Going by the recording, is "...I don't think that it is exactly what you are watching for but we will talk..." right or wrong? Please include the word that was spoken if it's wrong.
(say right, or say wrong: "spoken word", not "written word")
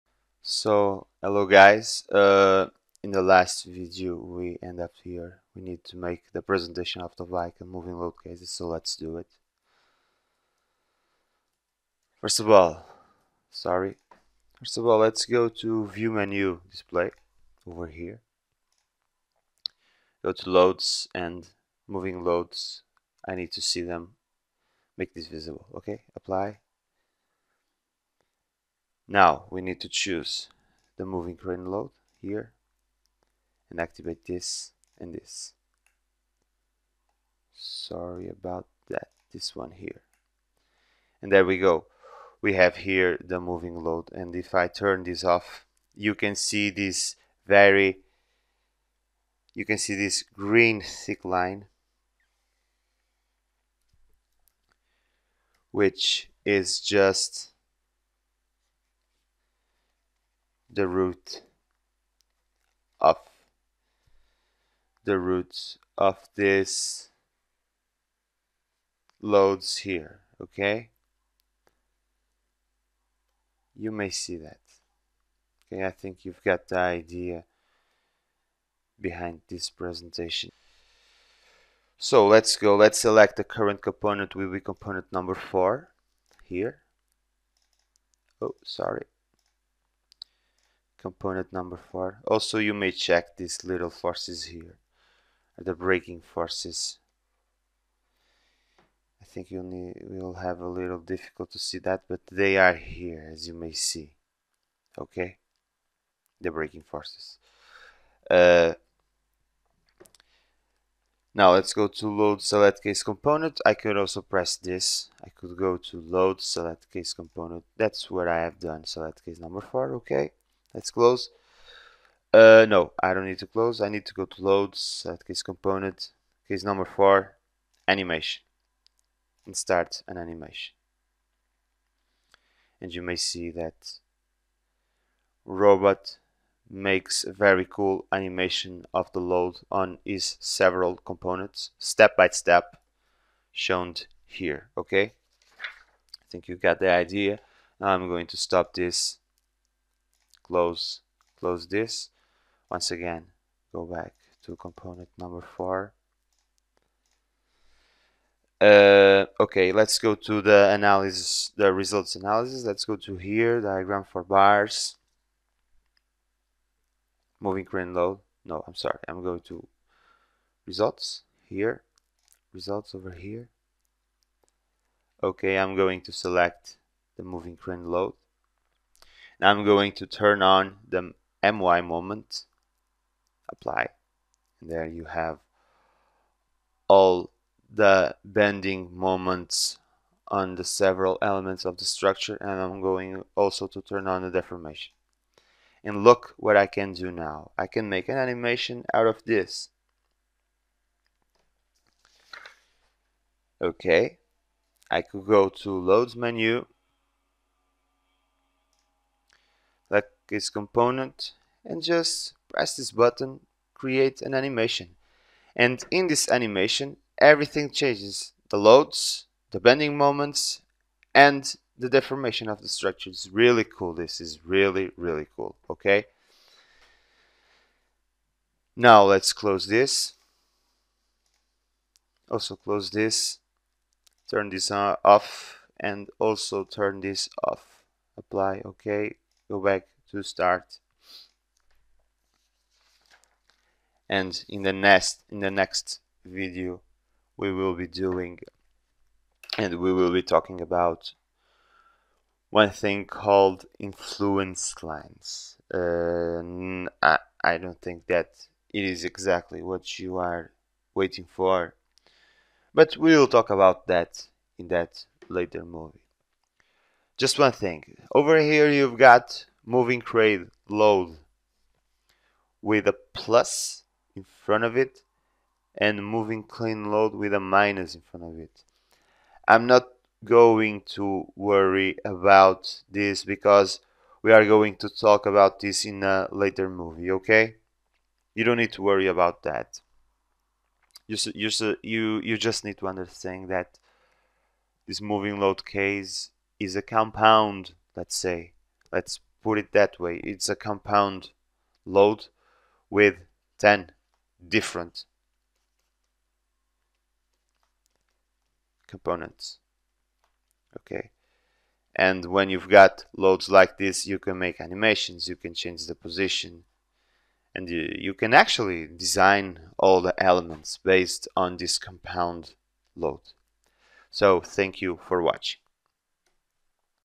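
wrong: "waiting", not "watching".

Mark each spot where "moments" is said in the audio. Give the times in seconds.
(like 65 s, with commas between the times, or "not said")
181 s, 188 s, 219 s.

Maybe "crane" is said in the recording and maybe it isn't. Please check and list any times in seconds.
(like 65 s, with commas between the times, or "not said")
31 s, 167 s, 177 s, 270 s, 276 s.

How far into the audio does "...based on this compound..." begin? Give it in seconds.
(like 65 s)
320 s.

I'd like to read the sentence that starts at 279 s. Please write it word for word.
I'm not going to worry about this because we are going to talk about this in a later movie, okay?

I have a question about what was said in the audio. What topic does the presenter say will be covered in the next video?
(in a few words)
Influence lines.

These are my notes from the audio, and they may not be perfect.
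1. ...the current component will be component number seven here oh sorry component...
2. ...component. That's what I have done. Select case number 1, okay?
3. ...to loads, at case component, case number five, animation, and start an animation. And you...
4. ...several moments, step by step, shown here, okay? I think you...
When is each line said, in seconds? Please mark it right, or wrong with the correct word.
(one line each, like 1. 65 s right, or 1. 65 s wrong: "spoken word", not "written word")
1. 83 s wrong: "four", not "seven"
2. 117 s wrong: "4", not "1"
3. 124 s wrong: "four", not "five"
4. 140 s wrong: "components", not "moments".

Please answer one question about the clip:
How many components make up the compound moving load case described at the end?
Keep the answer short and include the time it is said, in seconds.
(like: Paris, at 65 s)
10, at 303 s.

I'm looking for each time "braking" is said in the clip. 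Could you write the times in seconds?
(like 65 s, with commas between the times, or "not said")
95 s, 106 s.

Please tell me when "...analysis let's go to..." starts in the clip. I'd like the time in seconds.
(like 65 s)
162 s.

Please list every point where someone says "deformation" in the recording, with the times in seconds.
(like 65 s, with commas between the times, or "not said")
194 s, 221 s.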